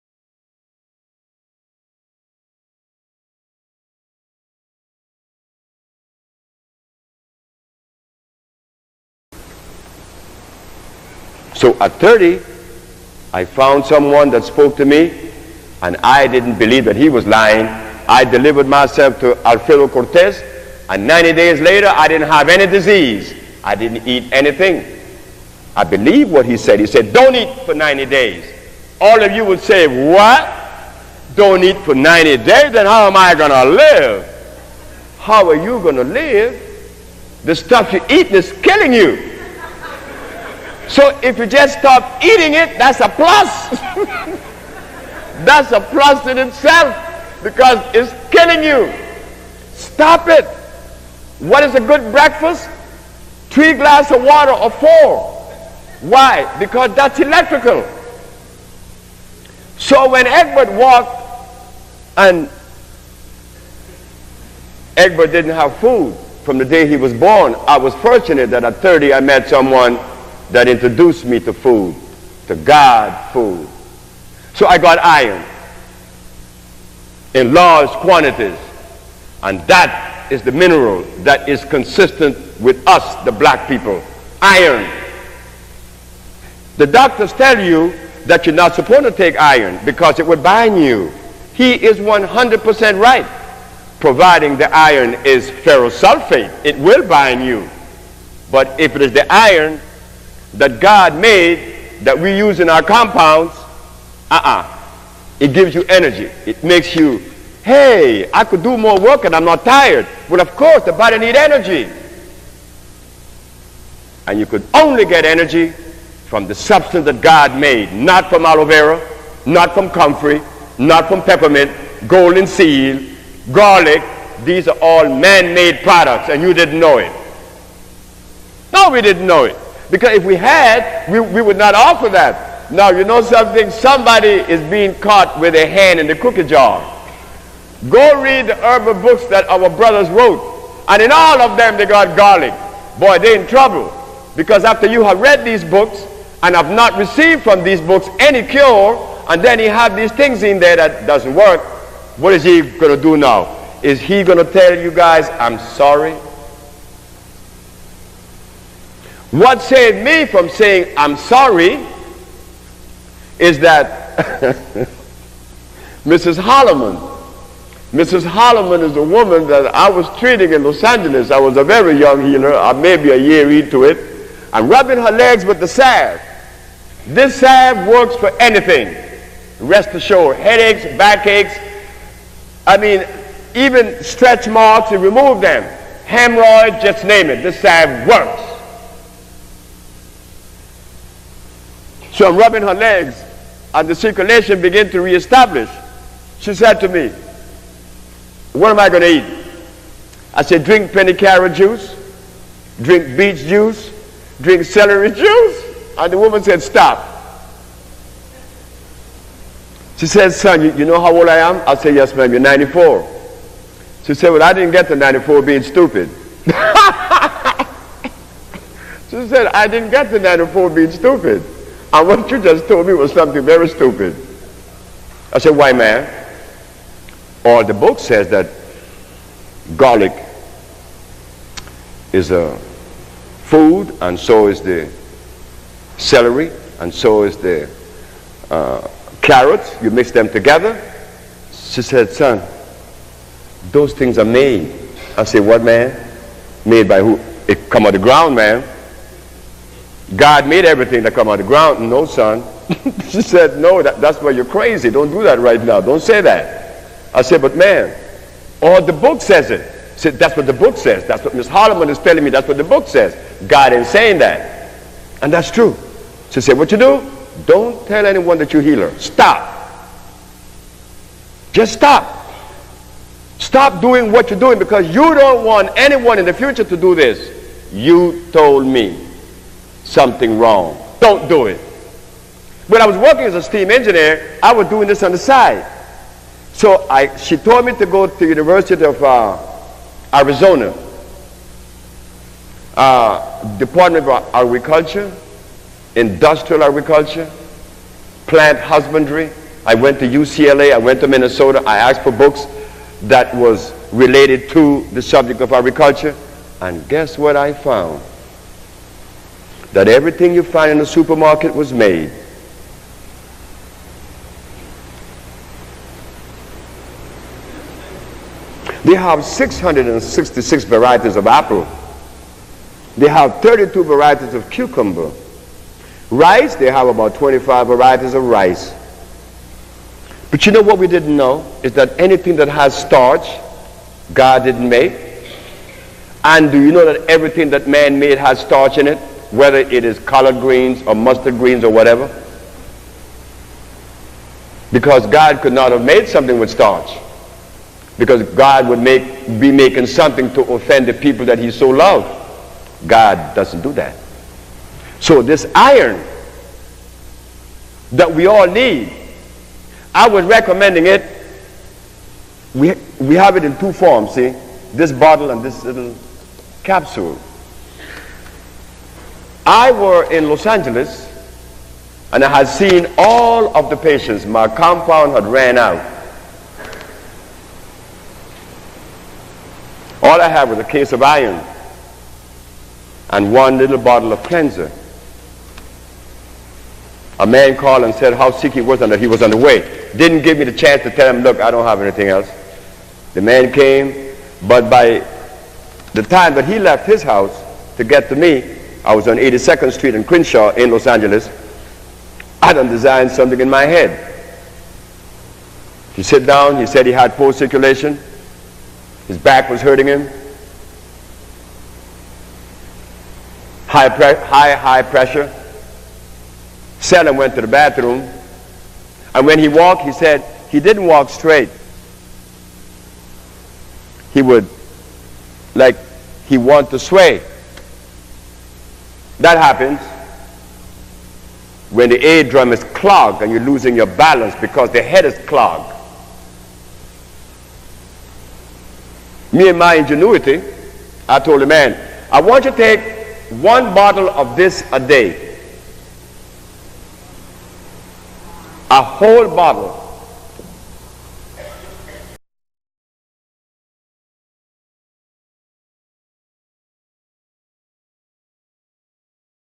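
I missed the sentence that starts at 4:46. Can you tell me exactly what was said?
So I, she told me to go to University of uh, Arizona, uh, Department of Agriculture, Industrial Agriculture, Plant Husbandry.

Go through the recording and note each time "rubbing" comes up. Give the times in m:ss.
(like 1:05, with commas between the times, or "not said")
2:54, 3:12.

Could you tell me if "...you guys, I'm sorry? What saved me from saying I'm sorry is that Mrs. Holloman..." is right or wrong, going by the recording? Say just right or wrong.
right.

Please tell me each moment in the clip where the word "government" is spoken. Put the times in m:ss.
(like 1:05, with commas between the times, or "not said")
not said.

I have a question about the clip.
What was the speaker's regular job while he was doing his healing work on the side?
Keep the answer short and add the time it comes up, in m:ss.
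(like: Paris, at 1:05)
steam engineer, at 4:43.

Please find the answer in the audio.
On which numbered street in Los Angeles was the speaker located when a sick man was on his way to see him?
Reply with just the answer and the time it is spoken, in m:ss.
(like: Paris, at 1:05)
82nd Street, at 6:39.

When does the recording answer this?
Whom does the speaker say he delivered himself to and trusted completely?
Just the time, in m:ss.
0:19.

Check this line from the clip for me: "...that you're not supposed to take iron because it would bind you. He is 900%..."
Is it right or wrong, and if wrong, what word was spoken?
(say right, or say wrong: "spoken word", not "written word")
wrong: "100", not "900".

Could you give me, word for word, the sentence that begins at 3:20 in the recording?
I said, drink penny carrot juice, drink beet juice, drink celery juice.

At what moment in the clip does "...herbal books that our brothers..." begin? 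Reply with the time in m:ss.
2:18.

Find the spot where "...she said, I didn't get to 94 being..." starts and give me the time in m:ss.
3:39.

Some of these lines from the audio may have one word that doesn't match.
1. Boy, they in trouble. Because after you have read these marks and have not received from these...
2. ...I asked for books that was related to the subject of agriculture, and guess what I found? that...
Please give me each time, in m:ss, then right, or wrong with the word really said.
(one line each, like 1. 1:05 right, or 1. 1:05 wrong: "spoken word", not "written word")
1. 2:22 wrong: "books", not "marks"
2. 5:01 right.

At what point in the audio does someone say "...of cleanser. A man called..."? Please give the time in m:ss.
6:24.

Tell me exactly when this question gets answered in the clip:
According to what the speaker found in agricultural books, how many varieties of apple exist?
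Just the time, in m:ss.
5:19.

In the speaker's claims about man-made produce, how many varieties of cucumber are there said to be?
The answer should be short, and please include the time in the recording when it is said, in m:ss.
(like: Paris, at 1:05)
32, at 5:23.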